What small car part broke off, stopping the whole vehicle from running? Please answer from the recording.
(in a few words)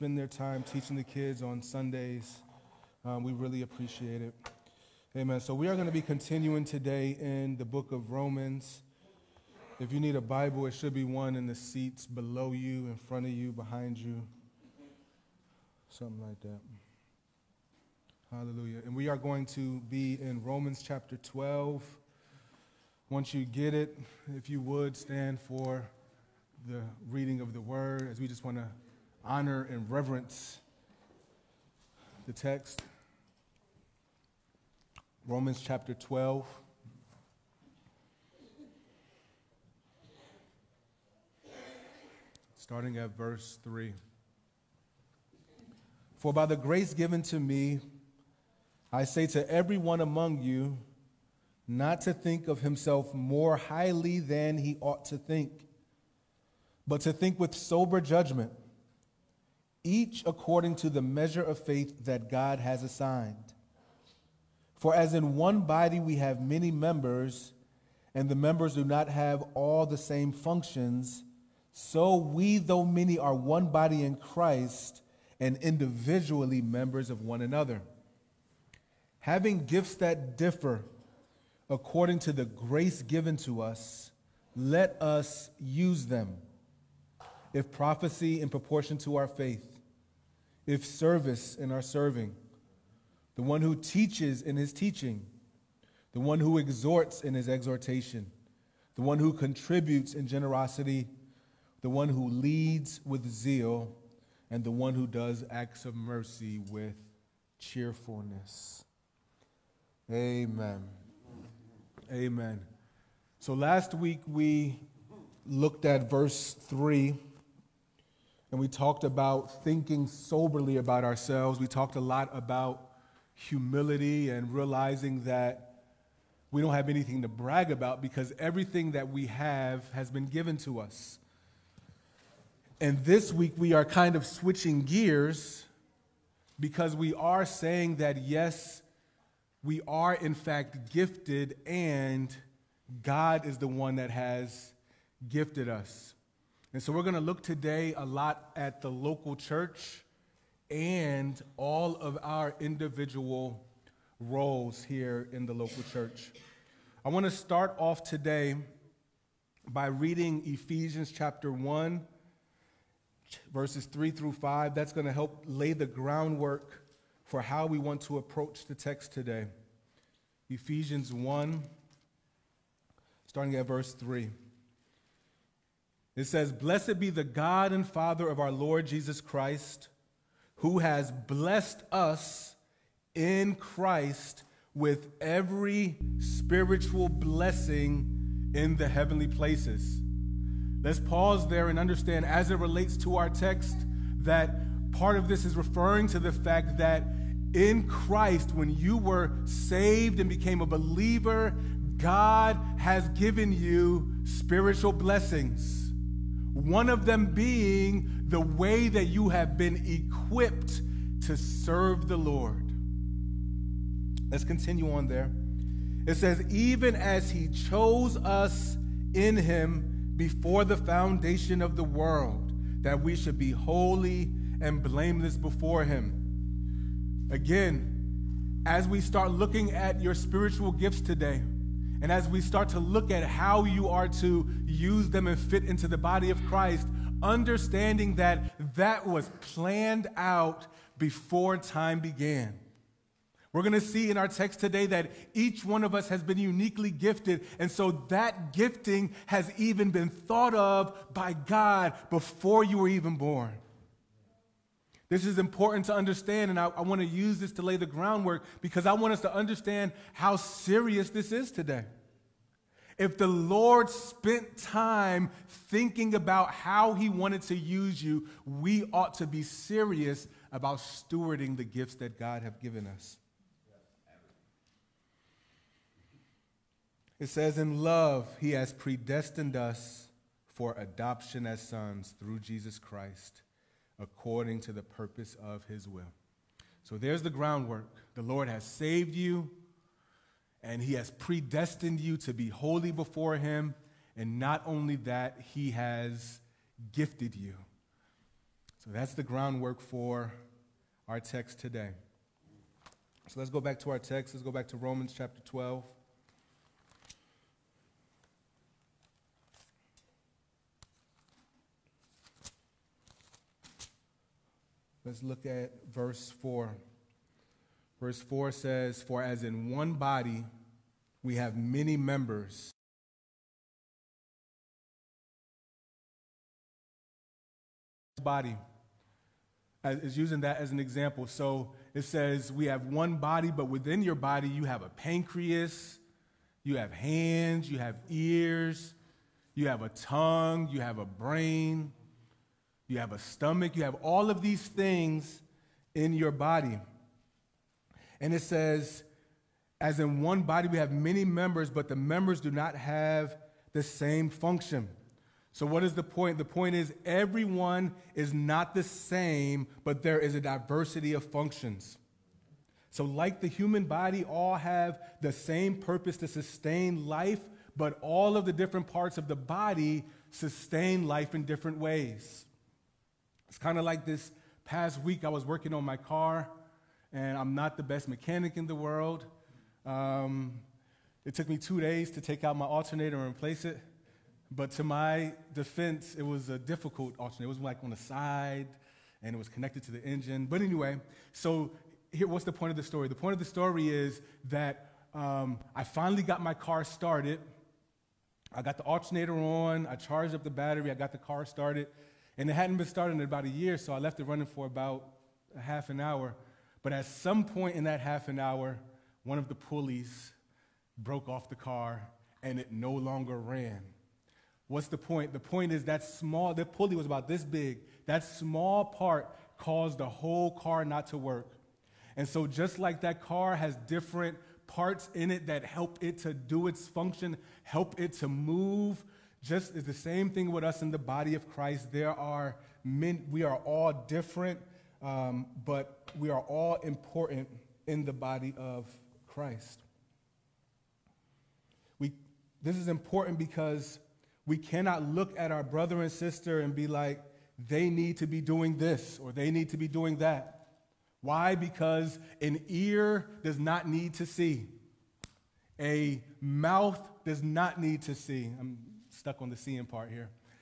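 pulley.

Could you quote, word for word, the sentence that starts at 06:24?
But to my defense, it was a difficult alternator.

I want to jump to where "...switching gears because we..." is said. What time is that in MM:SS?
02:14.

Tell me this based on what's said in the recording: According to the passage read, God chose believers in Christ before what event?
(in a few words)
the foundation of the world.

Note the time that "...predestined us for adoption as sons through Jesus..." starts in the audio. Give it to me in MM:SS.
04:38.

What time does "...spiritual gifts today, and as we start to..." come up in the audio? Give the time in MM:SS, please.
03:50.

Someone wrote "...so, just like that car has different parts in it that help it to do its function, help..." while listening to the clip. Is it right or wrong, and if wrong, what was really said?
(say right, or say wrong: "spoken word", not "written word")
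right.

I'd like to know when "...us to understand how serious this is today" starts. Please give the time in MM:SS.
04:19.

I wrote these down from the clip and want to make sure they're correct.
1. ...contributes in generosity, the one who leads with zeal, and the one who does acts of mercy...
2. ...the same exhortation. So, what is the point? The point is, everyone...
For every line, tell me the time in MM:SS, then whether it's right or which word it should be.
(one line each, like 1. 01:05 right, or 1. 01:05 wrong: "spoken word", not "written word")
1. 01:39 right
2. 05:53 wrong: "function", not "exhortation".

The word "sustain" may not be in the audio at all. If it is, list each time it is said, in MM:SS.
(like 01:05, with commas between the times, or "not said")
06:06, 06:10.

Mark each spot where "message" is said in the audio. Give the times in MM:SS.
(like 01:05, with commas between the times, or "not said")
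not said.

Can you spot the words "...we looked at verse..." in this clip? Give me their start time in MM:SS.
01:54.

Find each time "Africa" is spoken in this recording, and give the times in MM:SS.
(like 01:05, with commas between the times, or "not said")
not said.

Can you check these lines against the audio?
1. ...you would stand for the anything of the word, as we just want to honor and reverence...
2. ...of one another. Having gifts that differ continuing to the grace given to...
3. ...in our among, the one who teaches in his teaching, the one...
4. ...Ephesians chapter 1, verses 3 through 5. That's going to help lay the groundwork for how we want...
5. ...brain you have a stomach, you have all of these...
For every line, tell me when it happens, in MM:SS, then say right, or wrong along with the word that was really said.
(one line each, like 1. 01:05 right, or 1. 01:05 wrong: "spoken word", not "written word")
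1. 00:24 wrong: "reading", not "anything"
2. 01:17 wrong: "according", not "continuing"
3. 01:31 wrong: "serving", not "among"
4. 02:40 right
5. 05:41 right.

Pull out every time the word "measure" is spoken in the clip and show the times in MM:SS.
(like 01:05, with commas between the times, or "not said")
01:01.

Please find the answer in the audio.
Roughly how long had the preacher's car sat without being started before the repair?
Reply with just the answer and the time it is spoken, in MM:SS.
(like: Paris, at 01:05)
about a year, at 06:43.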